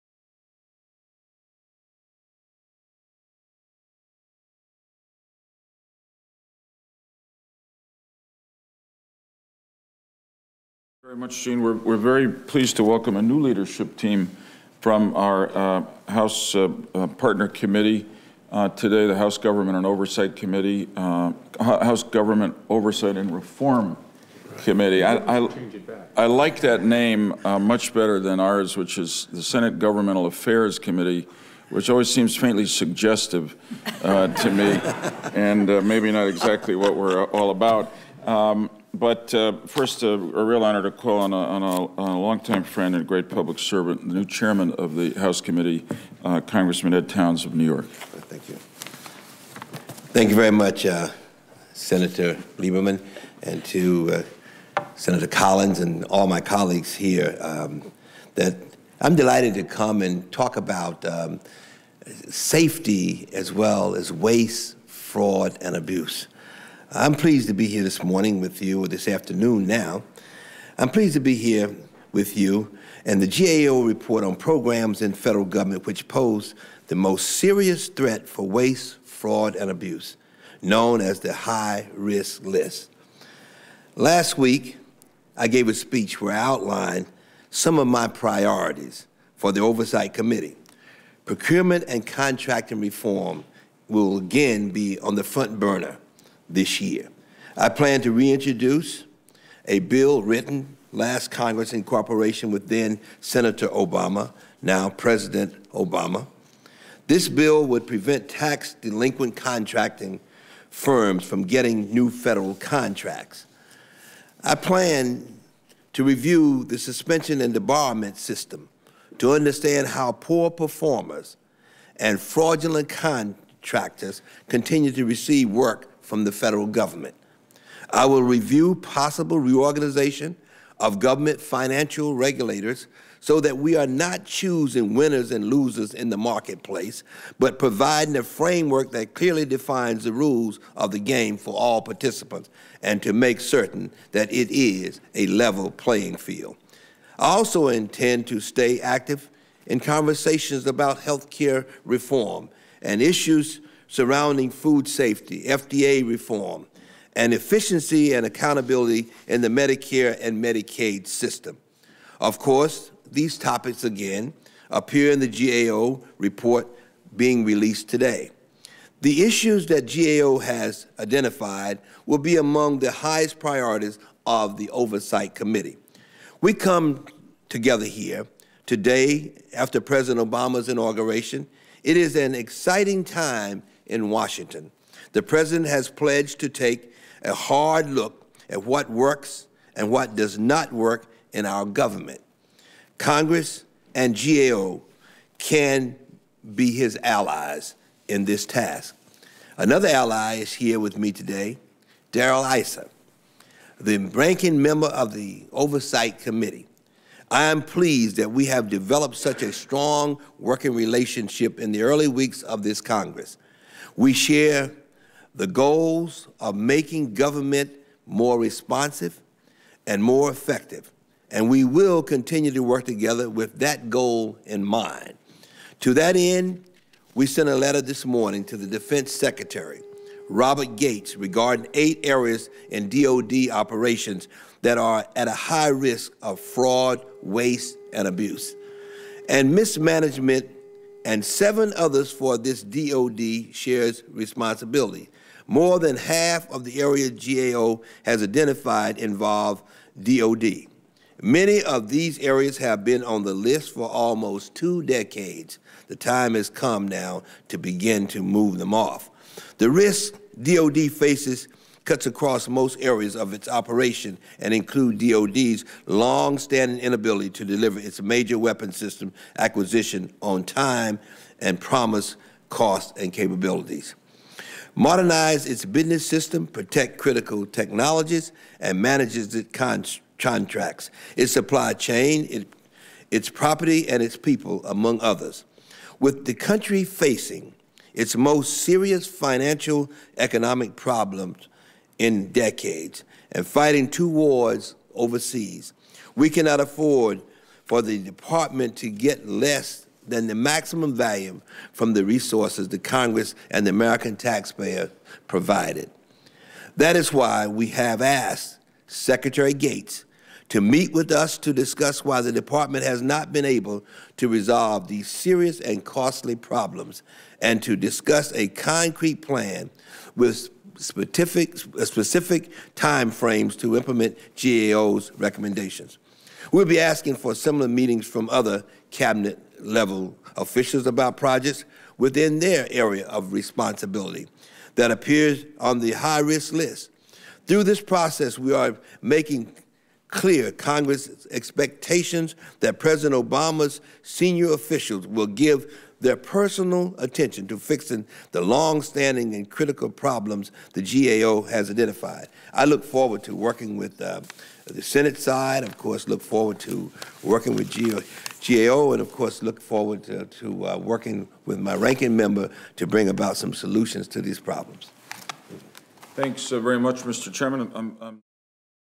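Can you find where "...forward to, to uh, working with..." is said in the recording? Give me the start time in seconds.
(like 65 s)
359 s.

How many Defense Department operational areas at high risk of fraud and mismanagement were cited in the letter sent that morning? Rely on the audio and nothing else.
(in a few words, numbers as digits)
8.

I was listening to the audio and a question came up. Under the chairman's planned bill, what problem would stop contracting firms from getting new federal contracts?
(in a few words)
tax delinquent.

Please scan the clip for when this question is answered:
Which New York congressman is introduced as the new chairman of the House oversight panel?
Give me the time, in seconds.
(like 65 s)
46 s.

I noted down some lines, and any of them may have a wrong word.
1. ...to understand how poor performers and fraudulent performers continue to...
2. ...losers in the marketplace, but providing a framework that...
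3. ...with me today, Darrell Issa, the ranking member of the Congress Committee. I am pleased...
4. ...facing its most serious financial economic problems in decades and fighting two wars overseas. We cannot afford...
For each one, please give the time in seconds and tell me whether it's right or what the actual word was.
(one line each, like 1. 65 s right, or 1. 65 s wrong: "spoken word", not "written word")
1. 119 s wrong: "contractors", not "performers"
2. 135 s right
3. 200 s wrong: "Oversight", not "Congress"
4. 286 s right.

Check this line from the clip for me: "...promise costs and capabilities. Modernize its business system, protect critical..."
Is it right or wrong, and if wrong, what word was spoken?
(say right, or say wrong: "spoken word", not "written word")
right.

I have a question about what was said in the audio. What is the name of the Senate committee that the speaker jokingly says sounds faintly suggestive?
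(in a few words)
Senate Governmental Affairs Committee.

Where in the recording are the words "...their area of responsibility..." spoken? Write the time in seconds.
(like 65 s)
332 s.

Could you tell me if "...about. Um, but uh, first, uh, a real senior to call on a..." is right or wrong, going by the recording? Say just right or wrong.
wrong.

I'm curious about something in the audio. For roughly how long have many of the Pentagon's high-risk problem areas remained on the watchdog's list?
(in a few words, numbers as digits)
almost two decades.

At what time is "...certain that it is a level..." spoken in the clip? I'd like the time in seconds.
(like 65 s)
143 s.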